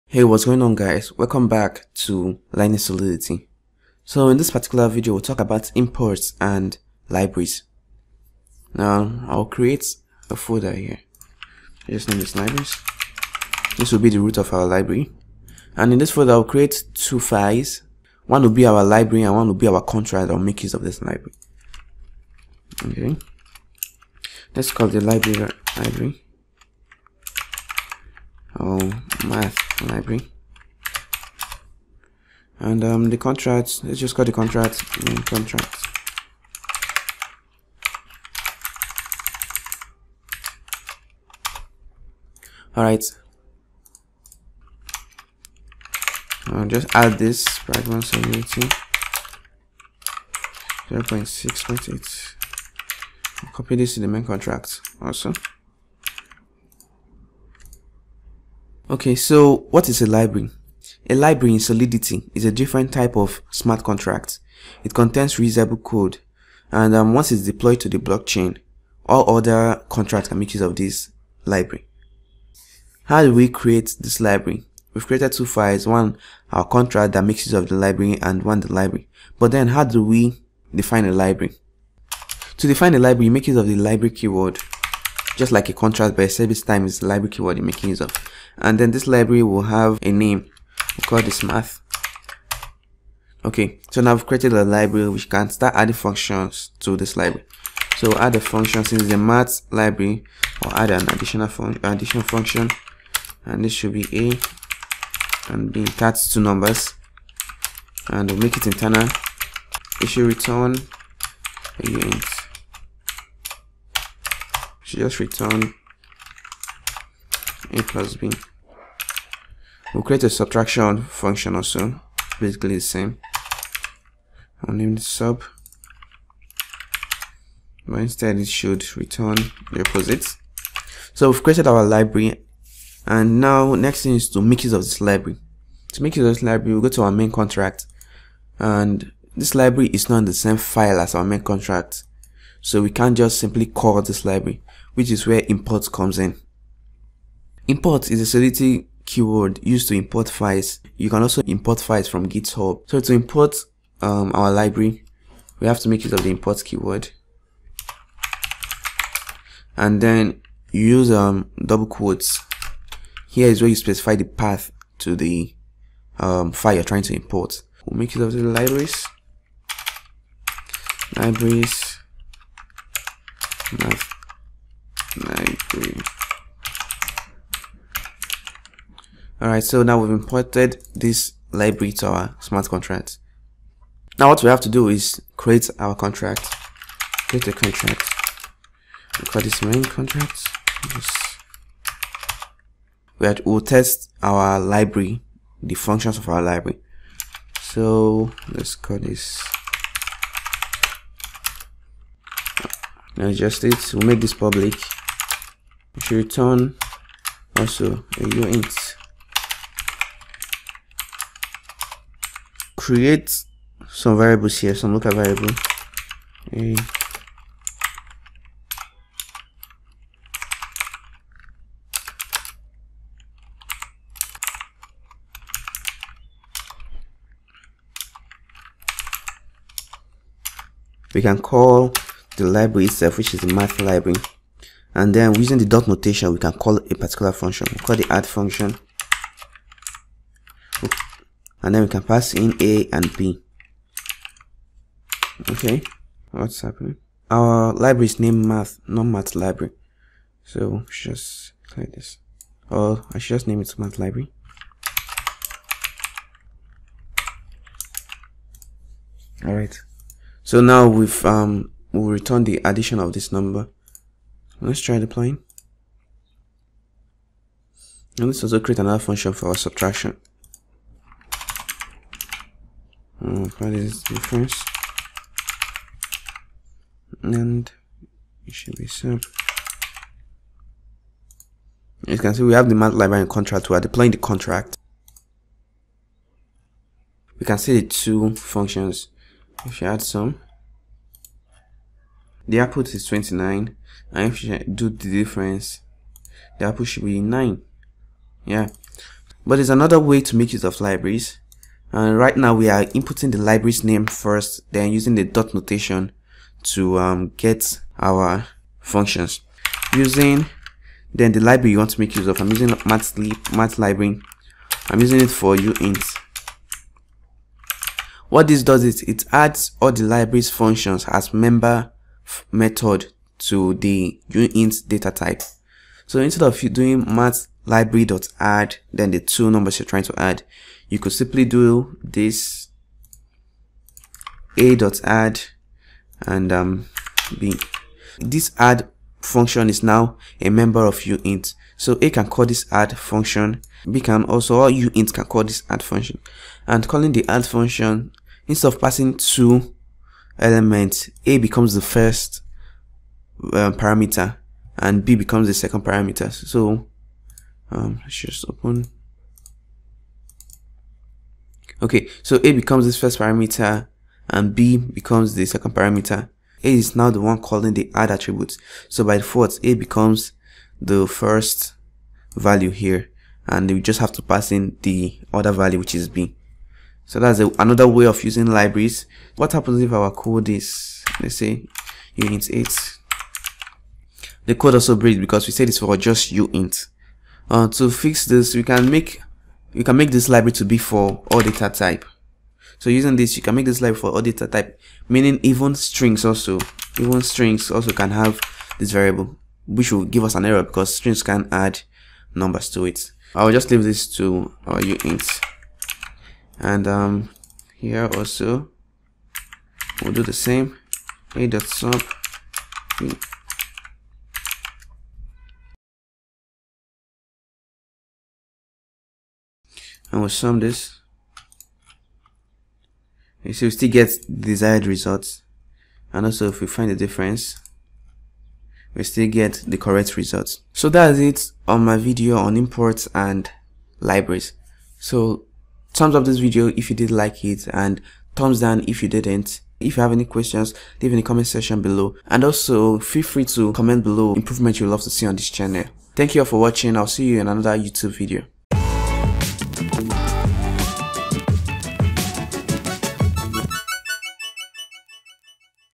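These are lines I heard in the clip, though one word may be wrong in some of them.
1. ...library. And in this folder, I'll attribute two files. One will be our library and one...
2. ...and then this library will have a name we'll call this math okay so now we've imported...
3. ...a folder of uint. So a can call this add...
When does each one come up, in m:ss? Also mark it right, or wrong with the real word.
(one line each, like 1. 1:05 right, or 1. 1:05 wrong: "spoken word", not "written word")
1. 0:14 wrong: "create", not "attribute"
2. 1:28 wrong: "created", not "imported"
3. 5:40 wrong: "member", not "folder".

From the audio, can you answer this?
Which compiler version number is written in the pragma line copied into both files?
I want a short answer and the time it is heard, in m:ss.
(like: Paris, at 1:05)
0.6.8, at 0:50.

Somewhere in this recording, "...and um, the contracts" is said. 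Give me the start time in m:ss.
0:32.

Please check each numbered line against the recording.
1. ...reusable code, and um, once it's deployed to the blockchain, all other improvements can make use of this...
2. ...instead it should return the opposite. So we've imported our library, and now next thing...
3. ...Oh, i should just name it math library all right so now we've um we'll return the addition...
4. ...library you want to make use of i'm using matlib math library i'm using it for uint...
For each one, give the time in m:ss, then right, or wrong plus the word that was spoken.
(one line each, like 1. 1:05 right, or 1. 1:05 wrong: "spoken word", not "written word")
1. 1:05 wrong: "contracts", not "improvements"
2. 2:08 wrong: "created", not "imported"
3. 4:12 right
4. 5:11 right.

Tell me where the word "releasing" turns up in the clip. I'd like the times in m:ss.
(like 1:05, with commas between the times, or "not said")
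not said.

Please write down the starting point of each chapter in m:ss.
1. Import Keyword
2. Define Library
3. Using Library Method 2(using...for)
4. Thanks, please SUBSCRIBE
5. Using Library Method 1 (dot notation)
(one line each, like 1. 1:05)
1. 2:27
2. 1:21
3. 5:07
4. 7:10
5. 3:51.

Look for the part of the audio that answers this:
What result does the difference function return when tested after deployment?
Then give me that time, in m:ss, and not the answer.
4:56.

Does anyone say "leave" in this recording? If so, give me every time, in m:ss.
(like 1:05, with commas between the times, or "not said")
6:43, 7:21.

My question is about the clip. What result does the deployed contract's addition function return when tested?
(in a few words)
29.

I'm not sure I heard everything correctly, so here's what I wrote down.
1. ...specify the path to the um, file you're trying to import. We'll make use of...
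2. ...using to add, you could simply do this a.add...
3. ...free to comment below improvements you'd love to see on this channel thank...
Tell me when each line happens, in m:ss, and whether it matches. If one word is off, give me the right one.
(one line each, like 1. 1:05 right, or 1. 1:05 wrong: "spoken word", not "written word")
1. 2:43 right
2. 5:29 wrong: "trying", not "using"
3. 7:23 right.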